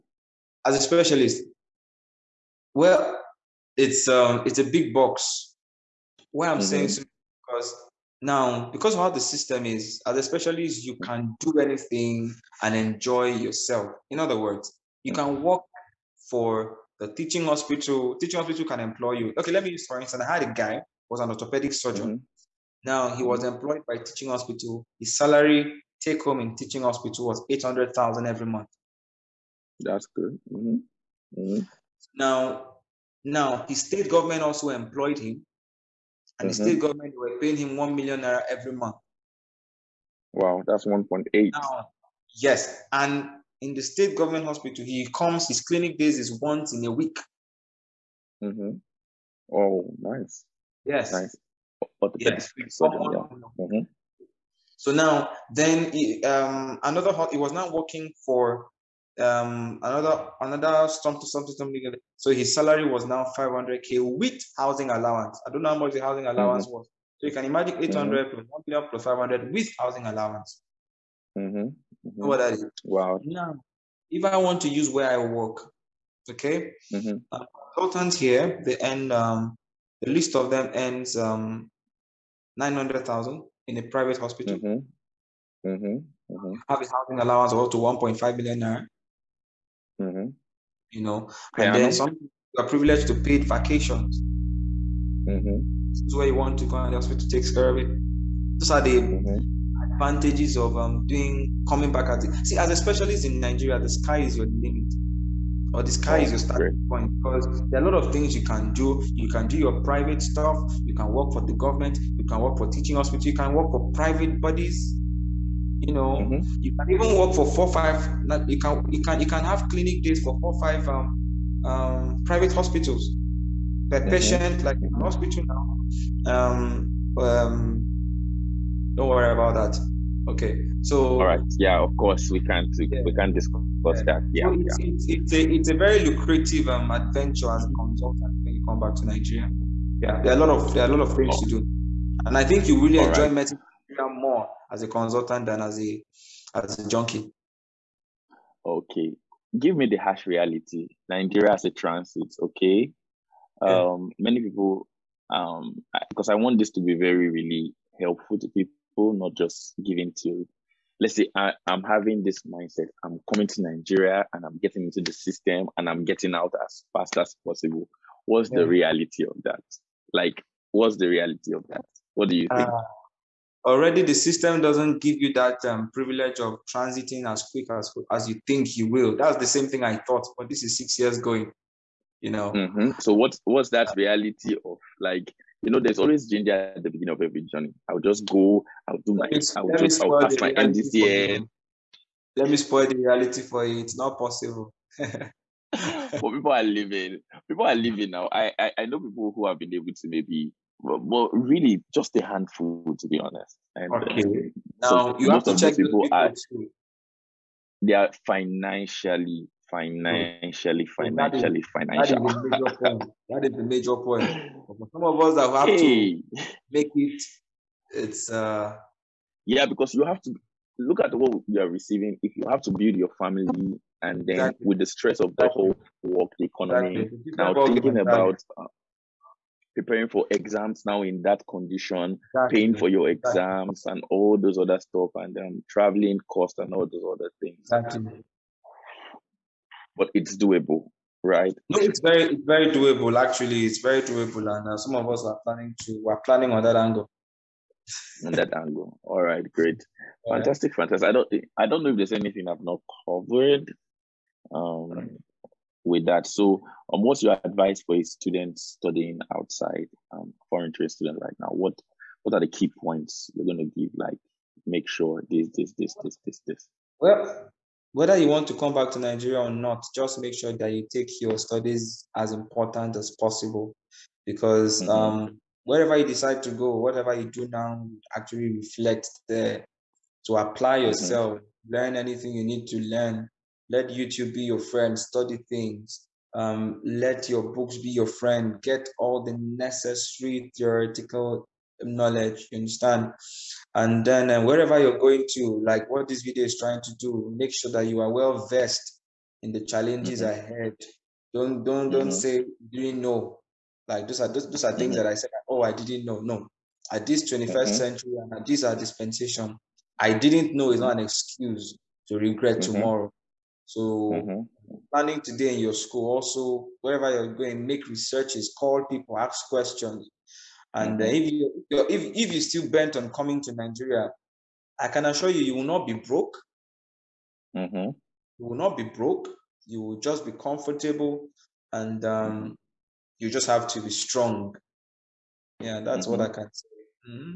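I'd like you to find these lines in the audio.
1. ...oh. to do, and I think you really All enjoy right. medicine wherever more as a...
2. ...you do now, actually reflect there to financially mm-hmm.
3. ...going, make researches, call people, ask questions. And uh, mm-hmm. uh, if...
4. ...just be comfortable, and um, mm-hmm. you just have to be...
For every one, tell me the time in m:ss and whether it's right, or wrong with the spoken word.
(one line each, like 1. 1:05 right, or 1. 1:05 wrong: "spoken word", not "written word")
1. 2:21 wrong: "career", not "wherever"
2. 4:37 wrong: "apply", not "financially"
3. 5:17 right
4. 5:29 right.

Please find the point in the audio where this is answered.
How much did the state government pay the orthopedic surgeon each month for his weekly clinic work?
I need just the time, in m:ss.
0:37.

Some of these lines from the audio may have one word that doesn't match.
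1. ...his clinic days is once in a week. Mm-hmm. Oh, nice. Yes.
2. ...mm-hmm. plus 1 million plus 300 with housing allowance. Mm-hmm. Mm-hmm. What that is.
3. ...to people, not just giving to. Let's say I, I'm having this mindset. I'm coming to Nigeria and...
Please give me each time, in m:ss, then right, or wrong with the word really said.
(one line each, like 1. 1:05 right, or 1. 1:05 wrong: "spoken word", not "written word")
1. 0:45 right
2. 1:08 wrong: "500", not "300"
3. 2:38 right.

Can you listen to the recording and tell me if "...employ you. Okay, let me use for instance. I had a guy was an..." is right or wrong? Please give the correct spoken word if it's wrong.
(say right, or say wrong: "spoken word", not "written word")
right.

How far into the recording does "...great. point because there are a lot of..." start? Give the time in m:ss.
1:46.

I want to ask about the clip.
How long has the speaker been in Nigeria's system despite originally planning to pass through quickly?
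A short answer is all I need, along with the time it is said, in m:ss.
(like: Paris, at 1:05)
6 years, at 3:00.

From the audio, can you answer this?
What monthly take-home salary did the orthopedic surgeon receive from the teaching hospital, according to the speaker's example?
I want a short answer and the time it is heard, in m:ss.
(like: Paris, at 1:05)
800,000 naira, at 0:27.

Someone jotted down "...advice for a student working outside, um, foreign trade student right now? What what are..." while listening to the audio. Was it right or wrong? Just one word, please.
wrong.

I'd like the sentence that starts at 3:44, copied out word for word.
with the stress of the whole work, the economy, exactly.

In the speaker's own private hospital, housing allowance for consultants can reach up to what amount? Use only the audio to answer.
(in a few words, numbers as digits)
1.5 million naira.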